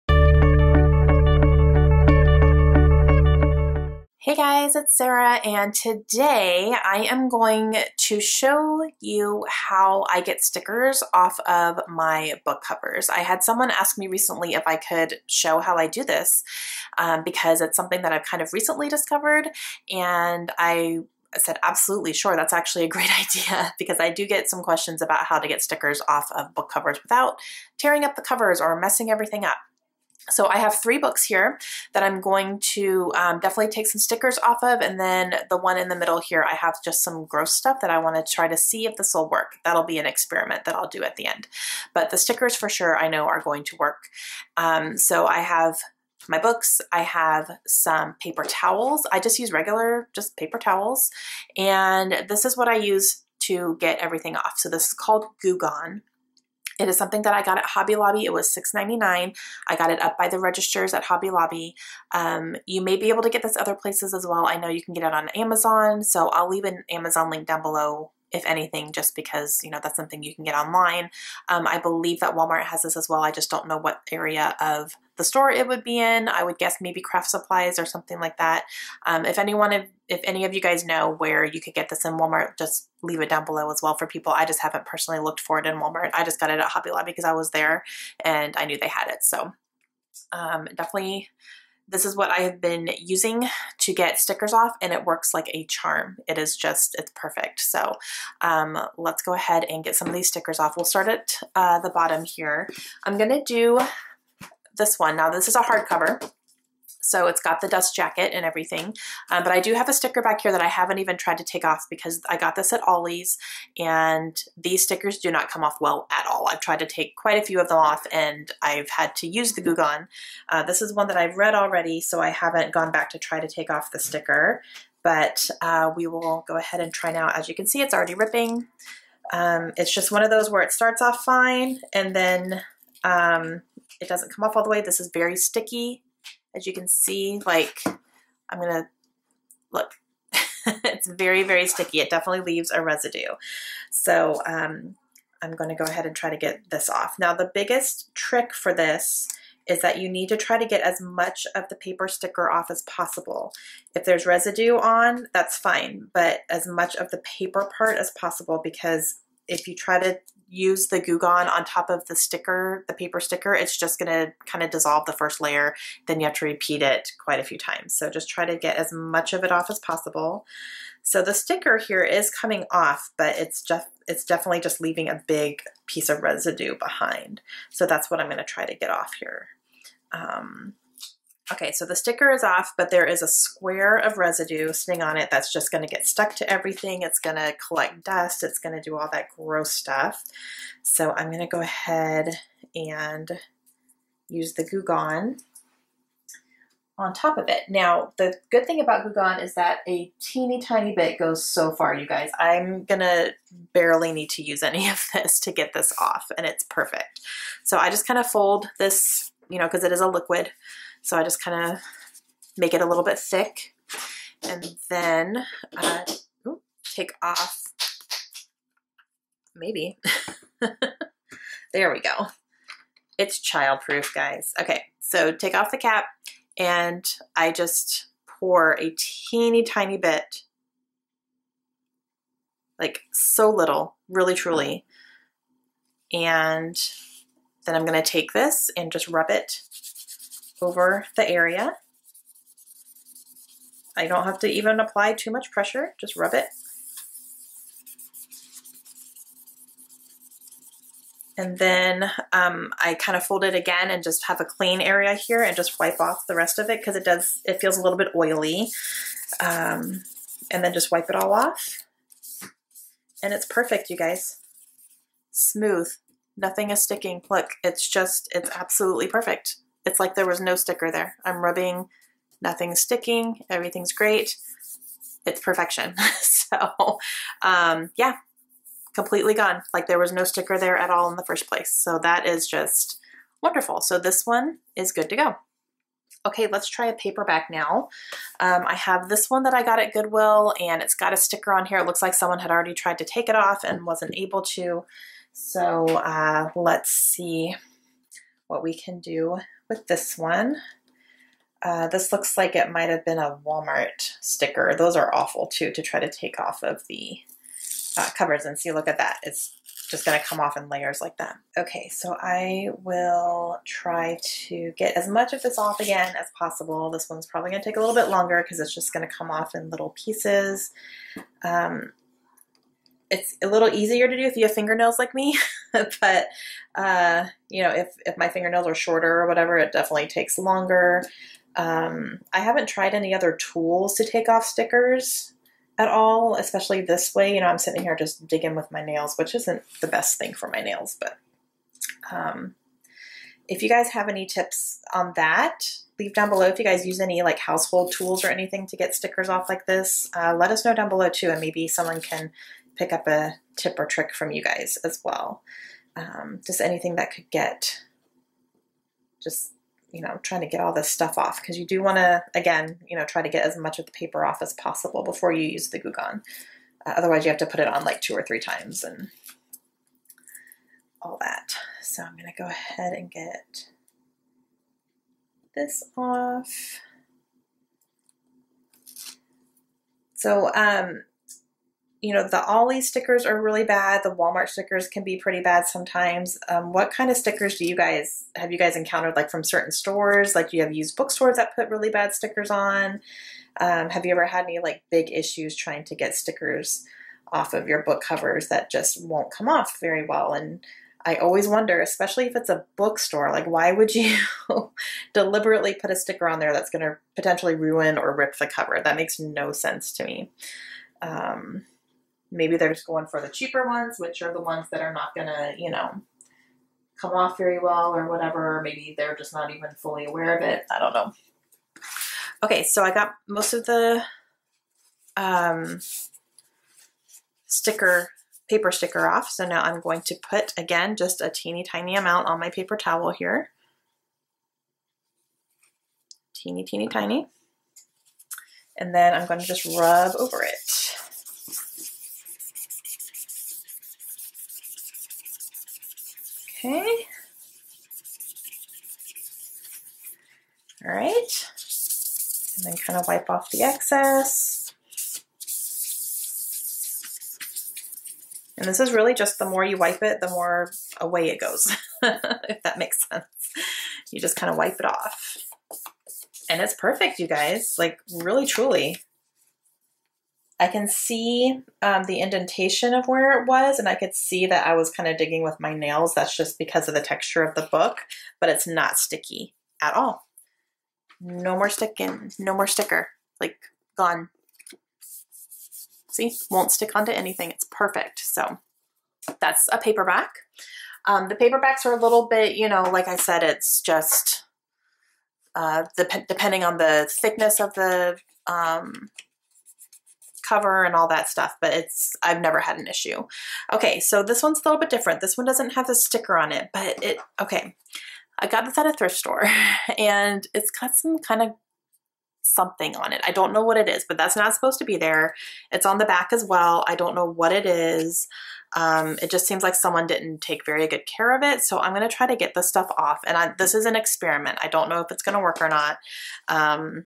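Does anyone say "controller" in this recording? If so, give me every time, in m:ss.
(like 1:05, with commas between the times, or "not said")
not said.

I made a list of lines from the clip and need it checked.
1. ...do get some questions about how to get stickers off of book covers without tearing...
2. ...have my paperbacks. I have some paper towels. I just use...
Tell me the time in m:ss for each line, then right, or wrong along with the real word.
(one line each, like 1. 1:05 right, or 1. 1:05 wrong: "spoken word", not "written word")
1. 0:24 right
2. 0:45 wrong: "books", not "paperbacks".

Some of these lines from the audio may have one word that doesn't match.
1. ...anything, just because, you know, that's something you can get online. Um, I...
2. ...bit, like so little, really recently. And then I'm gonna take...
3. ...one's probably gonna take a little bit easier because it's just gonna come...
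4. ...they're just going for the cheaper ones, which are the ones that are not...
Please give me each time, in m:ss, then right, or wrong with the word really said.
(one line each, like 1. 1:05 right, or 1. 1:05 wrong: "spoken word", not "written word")
1. 1:08 right
2. 3:49 wrong: "truly", not "recently"
3. 5:17 wrong: "longer", not "easier"
4. 6:52 right.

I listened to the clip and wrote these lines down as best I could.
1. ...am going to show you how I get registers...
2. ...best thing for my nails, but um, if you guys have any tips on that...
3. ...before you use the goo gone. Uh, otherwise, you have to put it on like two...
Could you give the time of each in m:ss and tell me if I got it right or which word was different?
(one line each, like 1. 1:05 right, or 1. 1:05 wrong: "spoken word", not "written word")
1. 0:07 wrong: "stickers", not "registers"
2. 5:39 right
3. 6:05 right.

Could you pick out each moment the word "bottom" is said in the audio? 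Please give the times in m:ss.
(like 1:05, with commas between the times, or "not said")
1:41.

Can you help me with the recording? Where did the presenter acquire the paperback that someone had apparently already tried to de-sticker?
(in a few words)
Goodwill.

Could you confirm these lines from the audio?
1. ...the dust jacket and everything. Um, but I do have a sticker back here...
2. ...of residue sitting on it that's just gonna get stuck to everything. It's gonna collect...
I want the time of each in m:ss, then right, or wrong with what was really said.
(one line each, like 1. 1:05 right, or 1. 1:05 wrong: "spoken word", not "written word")
1. 1:47 right
2. 3:03 right.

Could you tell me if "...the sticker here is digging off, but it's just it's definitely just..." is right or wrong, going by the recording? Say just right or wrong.
wrong.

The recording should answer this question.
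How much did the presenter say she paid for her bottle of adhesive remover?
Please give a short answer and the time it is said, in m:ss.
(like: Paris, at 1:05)
$6.99, at 0:58.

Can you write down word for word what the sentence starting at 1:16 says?
I would guess maybe craft supplies or something like that.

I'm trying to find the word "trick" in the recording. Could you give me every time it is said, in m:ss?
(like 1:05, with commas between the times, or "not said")
2:28, 5:53.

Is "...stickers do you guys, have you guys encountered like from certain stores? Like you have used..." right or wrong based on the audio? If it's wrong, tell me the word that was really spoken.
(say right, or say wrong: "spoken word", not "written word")
right.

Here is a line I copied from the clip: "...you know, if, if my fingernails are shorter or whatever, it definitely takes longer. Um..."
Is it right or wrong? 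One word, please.
right.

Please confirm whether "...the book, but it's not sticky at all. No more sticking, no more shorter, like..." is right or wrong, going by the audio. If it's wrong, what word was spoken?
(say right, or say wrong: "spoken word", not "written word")
wrong: "sticker", not "shorter".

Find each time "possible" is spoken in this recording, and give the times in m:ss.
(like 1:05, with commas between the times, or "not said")
2:32, 2:38, 2:49, 5:16, 6:04.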